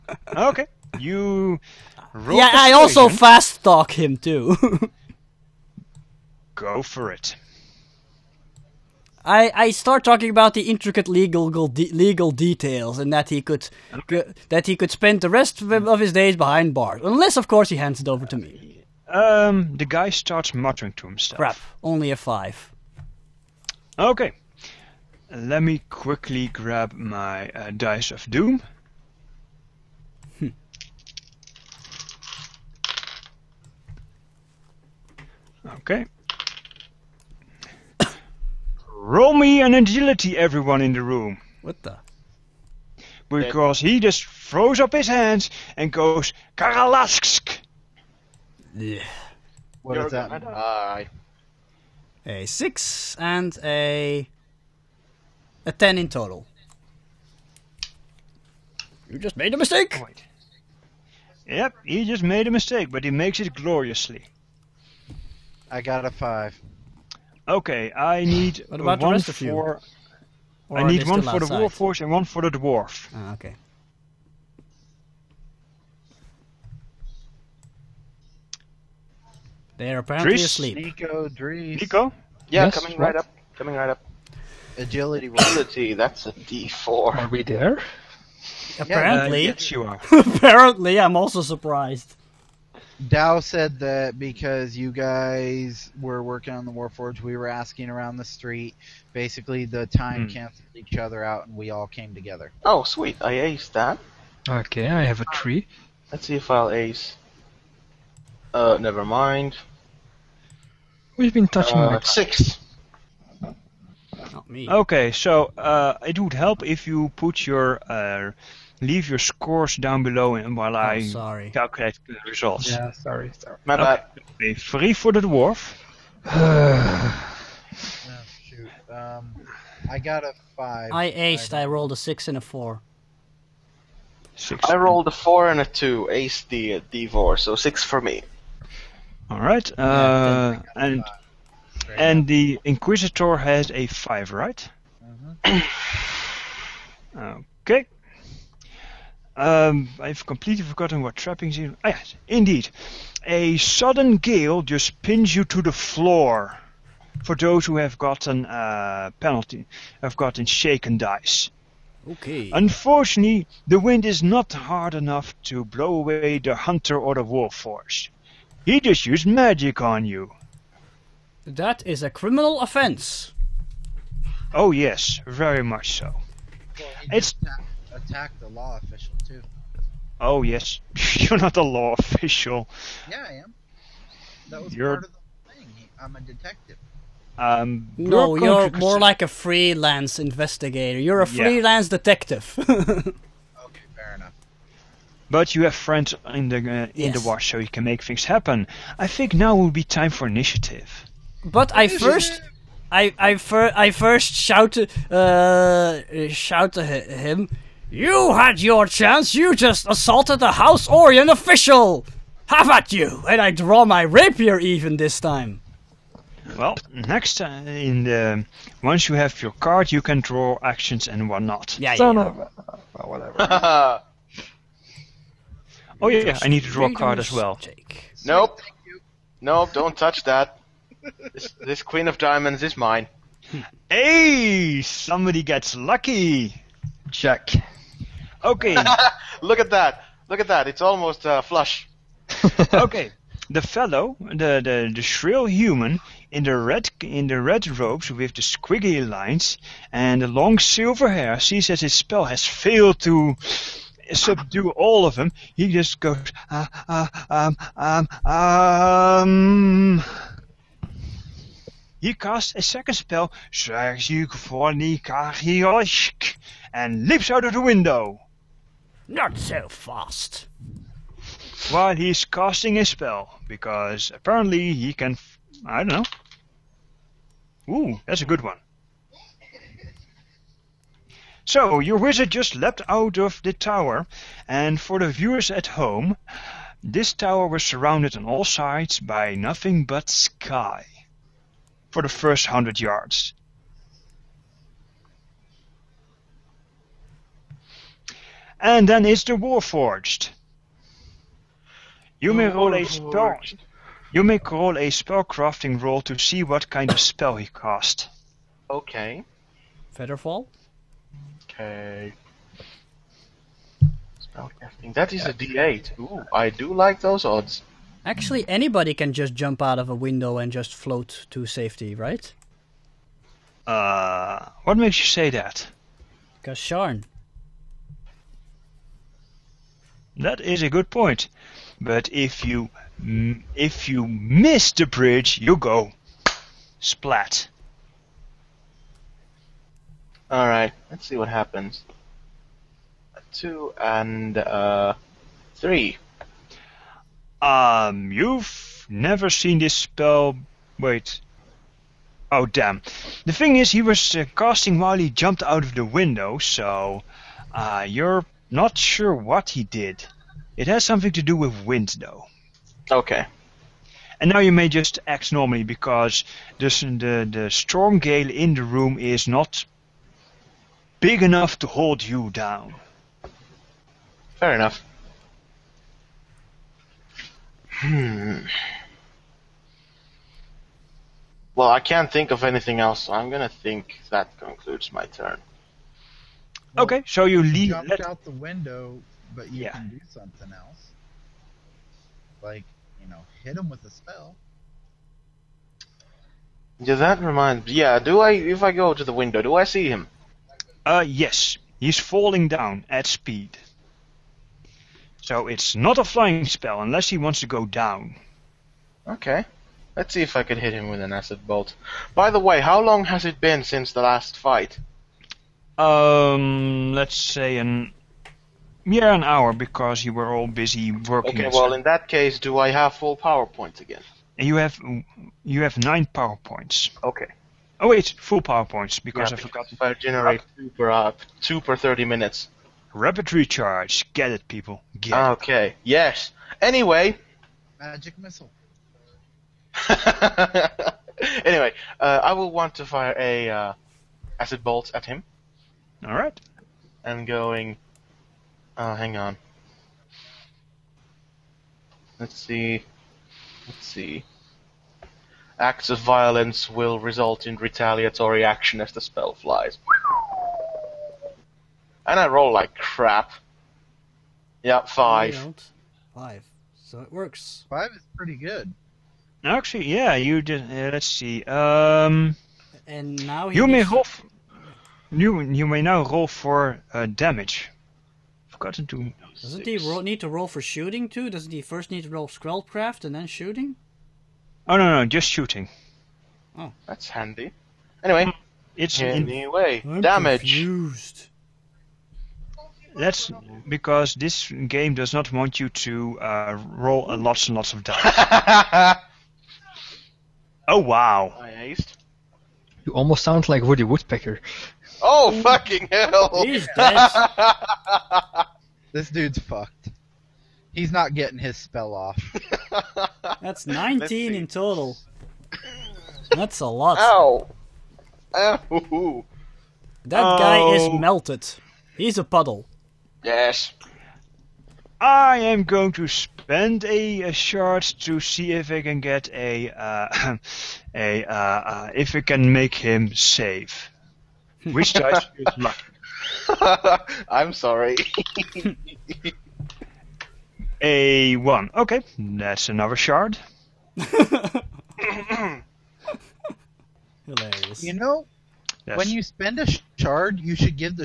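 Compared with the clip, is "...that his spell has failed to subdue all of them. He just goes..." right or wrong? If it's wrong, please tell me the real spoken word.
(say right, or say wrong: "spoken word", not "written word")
right.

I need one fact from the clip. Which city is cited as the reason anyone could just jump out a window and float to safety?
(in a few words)
Sharn.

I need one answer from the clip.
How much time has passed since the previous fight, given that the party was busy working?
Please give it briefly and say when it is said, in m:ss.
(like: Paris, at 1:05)
An hour, at 6:59.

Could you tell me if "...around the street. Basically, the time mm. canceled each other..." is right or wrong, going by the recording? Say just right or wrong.
right.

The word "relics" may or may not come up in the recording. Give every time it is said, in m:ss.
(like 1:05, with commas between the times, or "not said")
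not said.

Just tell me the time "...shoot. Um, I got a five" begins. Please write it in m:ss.
2:08.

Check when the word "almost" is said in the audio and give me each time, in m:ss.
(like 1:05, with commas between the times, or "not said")
4:00, 8:22.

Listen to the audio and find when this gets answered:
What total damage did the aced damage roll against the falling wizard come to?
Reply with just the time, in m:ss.
8:33.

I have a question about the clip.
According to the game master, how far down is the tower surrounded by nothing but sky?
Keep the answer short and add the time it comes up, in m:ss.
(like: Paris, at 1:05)
100 yards, at 4:52.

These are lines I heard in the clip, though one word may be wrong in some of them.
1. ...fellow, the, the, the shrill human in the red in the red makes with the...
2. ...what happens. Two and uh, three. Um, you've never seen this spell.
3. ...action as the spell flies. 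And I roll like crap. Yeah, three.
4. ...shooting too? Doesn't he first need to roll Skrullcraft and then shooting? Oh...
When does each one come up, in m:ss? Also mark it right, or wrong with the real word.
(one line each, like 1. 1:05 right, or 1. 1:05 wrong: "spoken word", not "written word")
1. 4:03 wrong: "robes", not "makes"
2. 5:41 right
3. 7:38 wrong: "five", not "three"
4. 8:00 right.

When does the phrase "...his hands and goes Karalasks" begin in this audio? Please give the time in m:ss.
0:44.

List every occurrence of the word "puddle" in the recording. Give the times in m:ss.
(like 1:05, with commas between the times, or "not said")
8:42.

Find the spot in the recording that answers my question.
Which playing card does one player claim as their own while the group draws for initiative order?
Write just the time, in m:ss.
3:51.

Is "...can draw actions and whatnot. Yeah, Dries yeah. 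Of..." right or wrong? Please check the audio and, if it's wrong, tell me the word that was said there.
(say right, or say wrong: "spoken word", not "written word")
wrong: "Son", not "Dries".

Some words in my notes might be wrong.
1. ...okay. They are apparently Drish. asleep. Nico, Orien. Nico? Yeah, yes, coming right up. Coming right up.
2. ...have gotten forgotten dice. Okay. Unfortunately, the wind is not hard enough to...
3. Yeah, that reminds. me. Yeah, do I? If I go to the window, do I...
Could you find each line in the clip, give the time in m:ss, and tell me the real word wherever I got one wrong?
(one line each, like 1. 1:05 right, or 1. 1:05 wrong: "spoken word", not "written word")
1. 1:13 wrong: "Dries", not "Orien"
2. 2:40 wrong: "shaken", not "forgotten"
3. 6:36 right.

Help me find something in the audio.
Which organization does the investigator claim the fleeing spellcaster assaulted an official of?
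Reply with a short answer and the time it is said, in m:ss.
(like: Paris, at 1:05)
House Orien, at 3:30.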